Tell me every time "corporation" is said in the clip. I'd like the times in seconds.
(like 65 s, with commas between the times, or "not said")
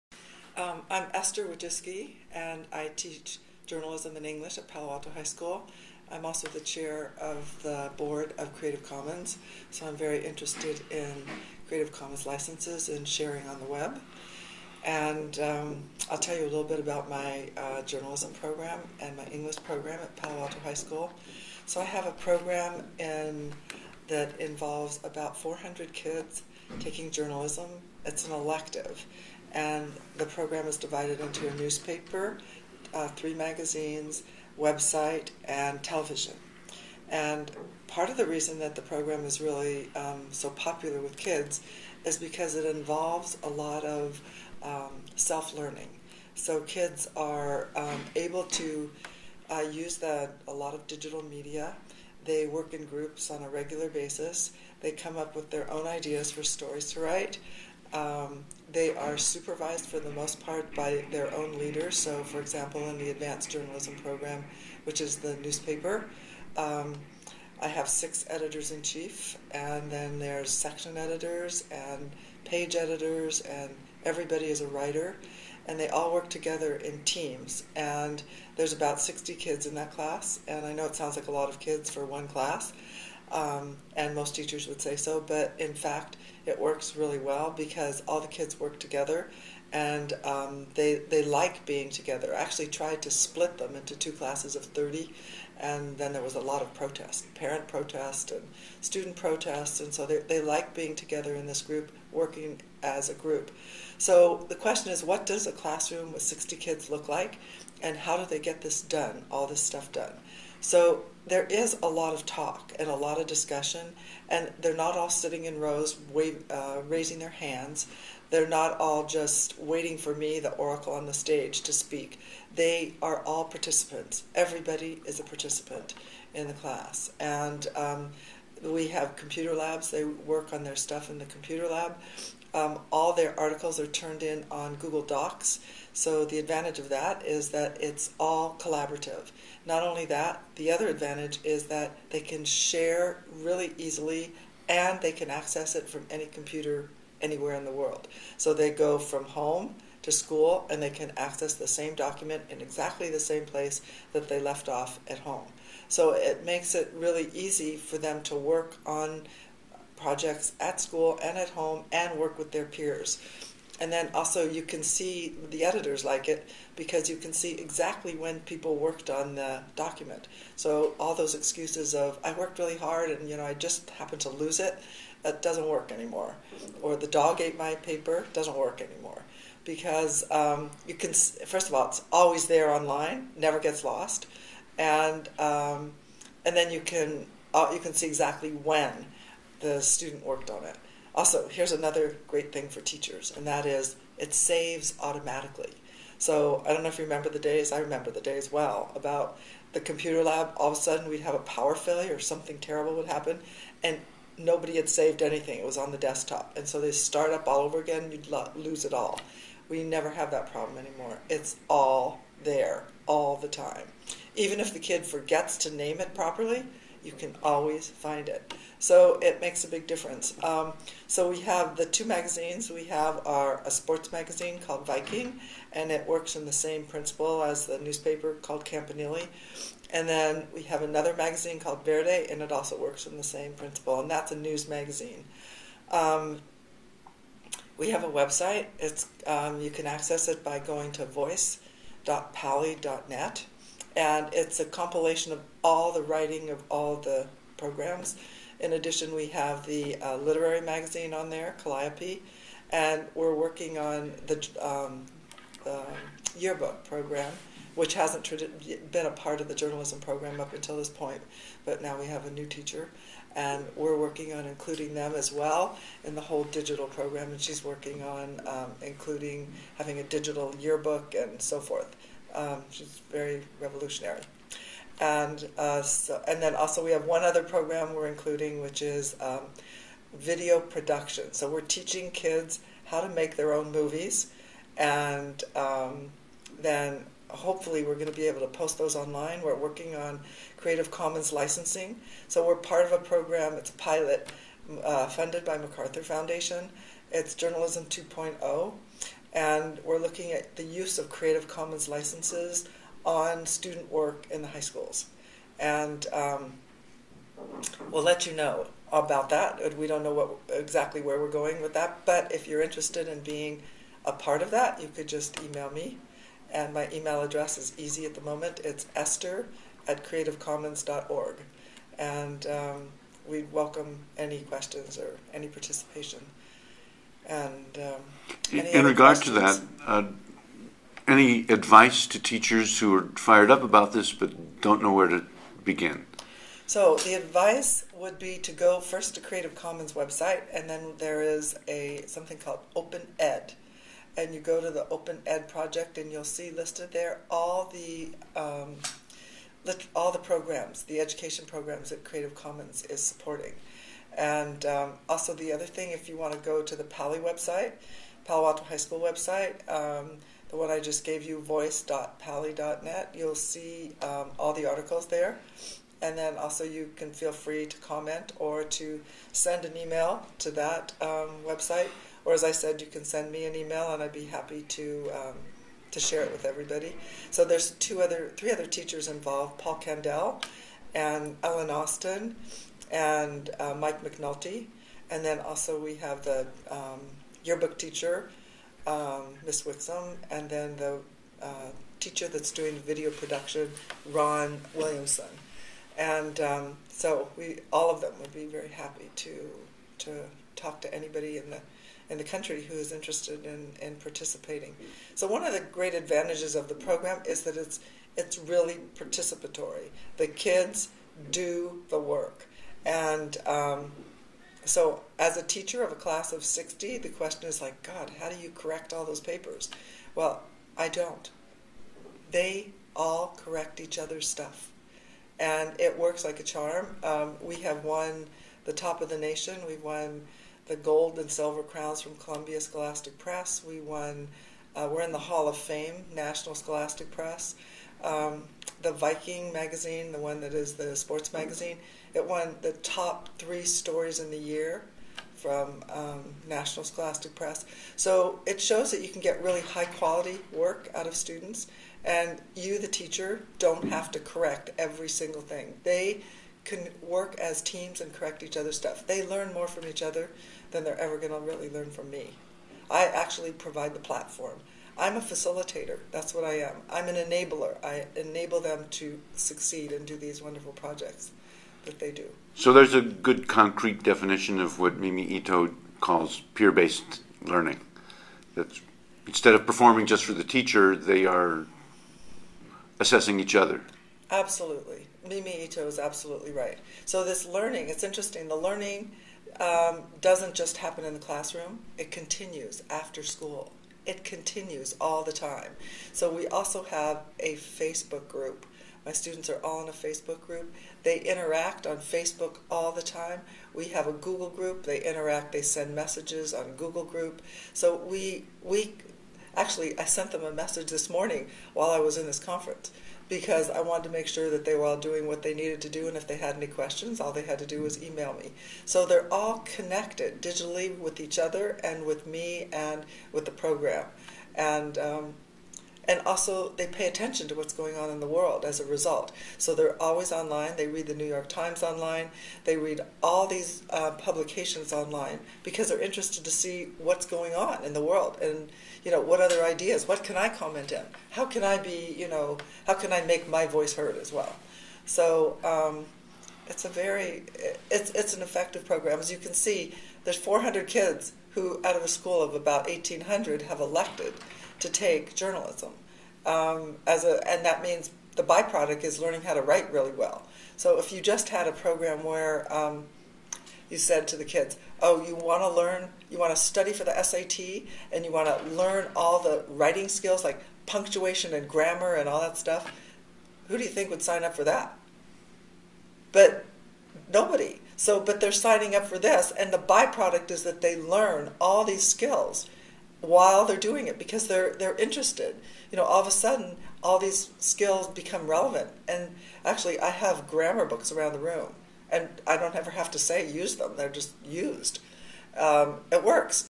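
not said.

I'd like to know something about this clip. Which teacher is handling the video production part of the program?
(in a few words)
Ron Williamson.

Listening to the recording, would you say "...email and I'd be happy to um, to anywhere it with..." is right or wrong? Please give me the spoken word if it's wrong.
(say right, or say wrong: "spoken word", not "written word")
wrong: "share", not "anywhere".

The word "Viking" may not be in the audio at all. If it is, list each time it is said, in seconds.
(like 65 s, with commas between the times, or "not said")
224 s, 438 s.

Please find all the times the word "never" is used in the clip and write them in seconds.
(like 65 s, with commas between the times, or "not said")
183 s, 209 s.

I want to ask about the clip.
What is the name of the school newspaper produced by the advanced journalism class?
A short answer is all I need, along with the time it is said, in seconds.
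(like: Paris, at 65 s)
Campanile, at 228 s.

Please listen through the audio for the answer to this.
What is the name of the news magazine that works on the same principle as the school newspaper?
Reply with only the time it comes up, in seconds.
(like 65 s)
231 s.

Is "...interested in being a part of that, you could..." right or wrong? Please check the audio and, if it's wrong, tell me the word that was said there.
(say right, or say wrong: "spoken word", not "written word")
right.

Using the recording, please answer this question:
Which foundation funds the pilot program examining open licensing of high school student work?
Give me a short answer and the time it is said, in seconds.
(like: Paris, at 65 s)
MacArthur Foundation, at 295 s.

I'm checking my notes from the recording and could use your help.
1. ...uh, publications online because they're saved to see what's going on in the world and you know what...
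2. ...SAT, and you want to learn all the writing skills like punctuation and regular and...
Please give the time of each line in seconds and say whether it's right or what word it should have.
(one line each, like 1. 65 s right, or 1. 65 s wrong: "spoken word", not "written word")
1. 533 s wrong: "interested", not "saved"
2. 567 s wrong: "grammar", not "regular".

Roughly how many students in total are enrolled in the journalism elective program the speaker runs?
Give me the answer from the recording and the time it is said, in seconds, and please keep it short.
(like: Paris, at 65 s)
400, at 25 s.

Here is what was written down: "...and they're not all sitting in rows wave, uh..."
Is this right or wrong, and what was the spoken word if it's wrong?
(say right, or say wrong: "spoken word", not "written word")
right.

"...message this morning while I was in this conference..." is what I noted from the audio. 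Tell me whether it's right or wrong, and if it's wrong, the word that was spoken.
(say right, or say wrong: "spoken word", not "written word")
right.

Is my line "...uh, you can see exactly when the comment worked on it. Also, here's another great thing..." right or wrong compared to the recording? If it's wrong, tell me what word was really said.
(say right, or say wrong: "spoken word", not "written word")
wrong: "student", not "comment".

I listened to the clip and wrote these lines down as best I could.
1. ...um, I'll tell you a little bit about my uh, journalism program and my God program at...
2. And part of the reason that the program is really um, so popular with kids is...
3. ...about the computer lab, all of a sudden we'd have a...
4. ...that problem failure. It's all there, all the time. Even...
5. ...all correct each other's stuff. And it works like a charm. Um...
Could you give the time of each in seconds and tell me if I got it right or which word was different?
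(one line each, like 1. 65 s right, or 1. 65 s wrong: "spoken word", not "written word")
1. 15 s wrong: "English", not "God"
2. 37 s right
3. 198 s right
4. 210 s wrong: "anymore", not "failure"
5. 422 s right.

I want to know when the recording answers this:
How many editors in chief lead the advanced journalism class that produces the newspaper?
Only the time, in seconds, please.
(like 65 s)
67 s.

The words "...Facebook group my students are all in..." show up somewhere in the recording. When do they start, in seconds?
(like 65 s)
497 s.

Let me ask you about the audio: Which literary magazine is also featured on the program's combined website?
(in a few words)
Calliope.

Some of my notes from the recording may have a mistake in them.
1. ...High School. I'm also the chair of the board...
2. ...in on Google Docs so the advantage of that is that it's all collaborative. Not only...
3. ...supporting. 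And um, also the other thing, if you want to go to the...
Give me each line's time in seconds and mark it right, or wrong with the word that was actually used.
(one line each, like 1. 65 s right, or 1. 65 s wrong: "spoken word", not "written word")
1. 5 s right
2. 134 s right
3. 353 s right.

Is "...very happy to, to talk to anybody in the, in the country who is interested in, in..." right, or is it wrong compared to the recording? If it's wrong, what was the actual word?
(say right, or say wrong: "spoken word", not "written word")
right.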